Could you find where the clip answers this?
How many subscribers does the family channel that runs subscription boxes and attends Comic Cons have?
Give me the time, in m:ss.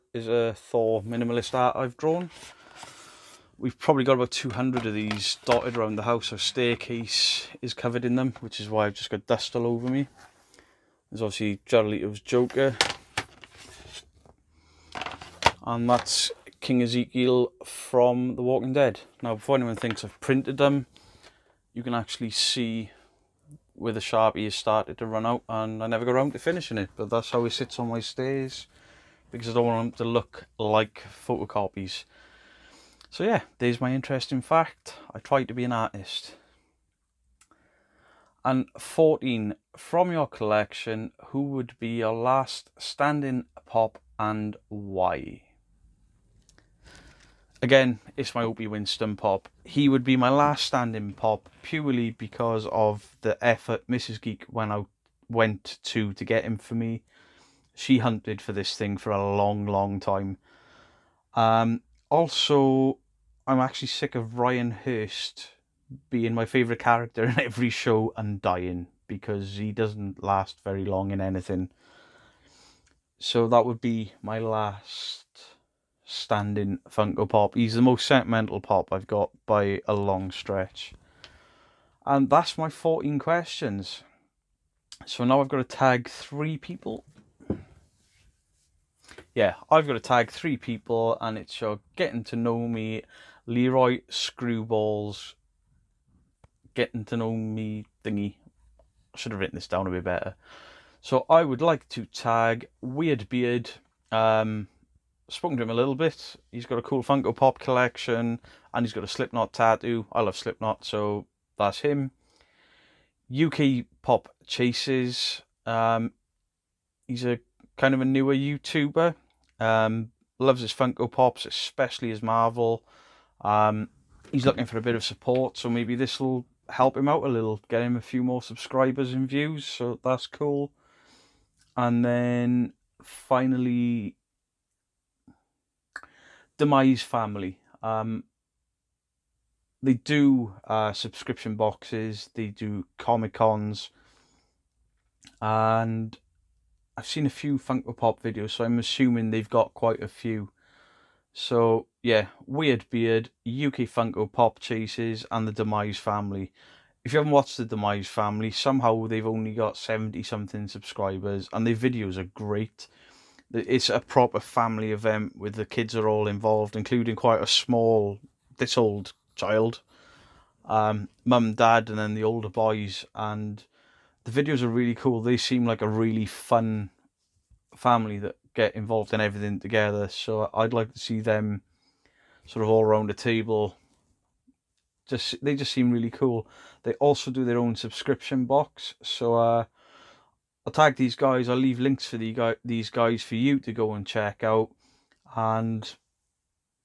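2:39.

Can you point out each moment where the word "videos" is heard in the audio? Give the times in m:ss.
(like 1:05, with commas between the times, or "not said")
2:28, 2:41, 2:54.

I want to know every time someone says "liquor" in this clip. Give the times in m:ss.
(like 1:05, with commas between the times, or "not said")
not said.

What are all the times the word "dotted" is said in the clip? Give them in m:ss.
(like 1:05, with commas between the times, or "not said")
0:05.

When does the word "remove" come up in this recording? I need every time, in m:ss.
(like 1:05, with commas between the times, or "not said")
not said.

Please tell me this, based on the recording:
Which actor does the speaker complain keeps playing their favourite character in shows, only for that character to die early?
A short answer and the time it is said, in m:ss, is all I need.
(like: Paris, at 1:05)
Ryan Hurst, at 1:04.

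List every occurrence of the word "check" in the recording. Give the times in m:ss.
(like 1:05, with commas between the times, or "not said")
3:14.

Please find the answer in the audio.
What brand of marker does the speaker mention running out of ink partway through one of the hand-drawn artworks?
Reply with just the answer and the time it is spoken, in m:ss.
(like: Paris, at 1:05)
Sharpie, at 0:23.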